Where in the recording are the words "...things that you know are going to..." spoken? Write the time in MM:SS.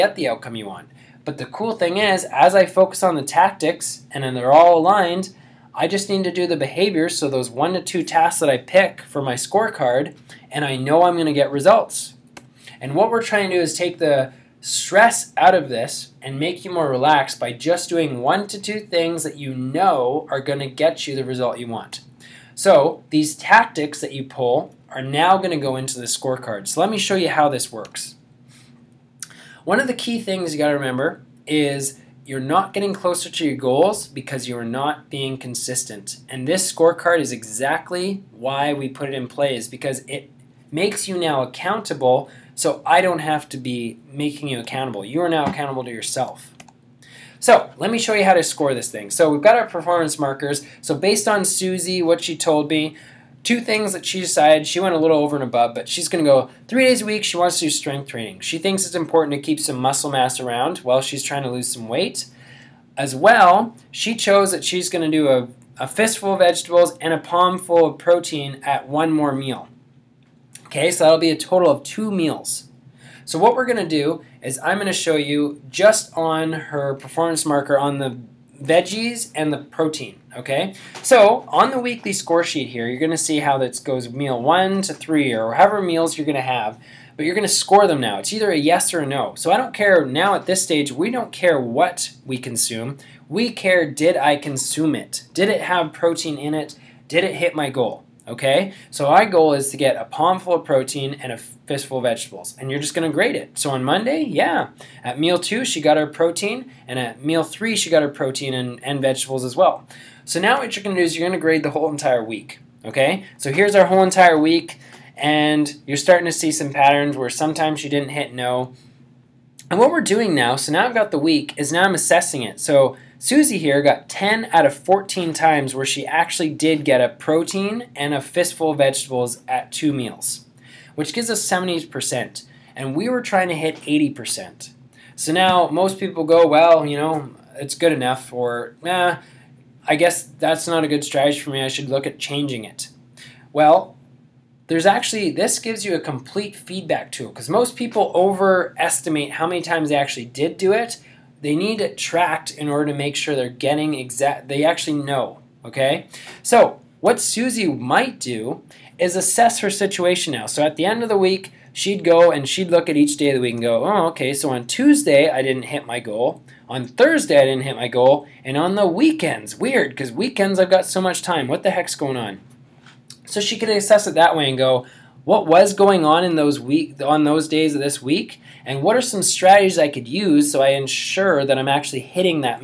00:18.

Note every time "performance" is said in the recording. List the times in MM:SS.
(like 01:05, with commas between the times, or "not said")
00:49, 01:16.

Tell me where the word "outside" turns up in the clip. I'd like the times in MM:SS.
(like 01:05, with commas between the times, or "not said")
not said.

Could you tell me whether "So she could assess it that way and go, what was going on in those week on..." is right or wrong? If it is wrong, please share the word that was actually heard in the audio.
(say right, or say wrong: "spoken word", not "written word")
right.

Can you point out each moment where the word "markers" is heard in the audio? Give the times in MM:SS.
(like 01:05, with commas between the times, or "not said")
00:50, 01:17.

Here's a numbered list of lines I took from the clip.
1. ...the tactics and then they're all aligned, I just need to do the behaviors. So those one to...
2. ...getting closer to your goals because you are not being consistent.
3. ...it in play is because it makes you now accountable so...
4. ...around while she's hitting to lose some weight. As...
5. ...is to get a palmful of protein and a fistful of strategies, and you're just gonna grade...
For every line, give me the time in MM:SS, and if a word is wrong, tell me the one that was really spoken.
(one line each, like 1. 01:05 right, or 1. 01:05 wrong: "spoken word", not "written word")
1. 00:03 right
2. 00:32 right
3. 00:39 right
4. 01:00 wrong: "trying", not "hitting"
5. 01:39 wrong: "vegetables", not "strategies".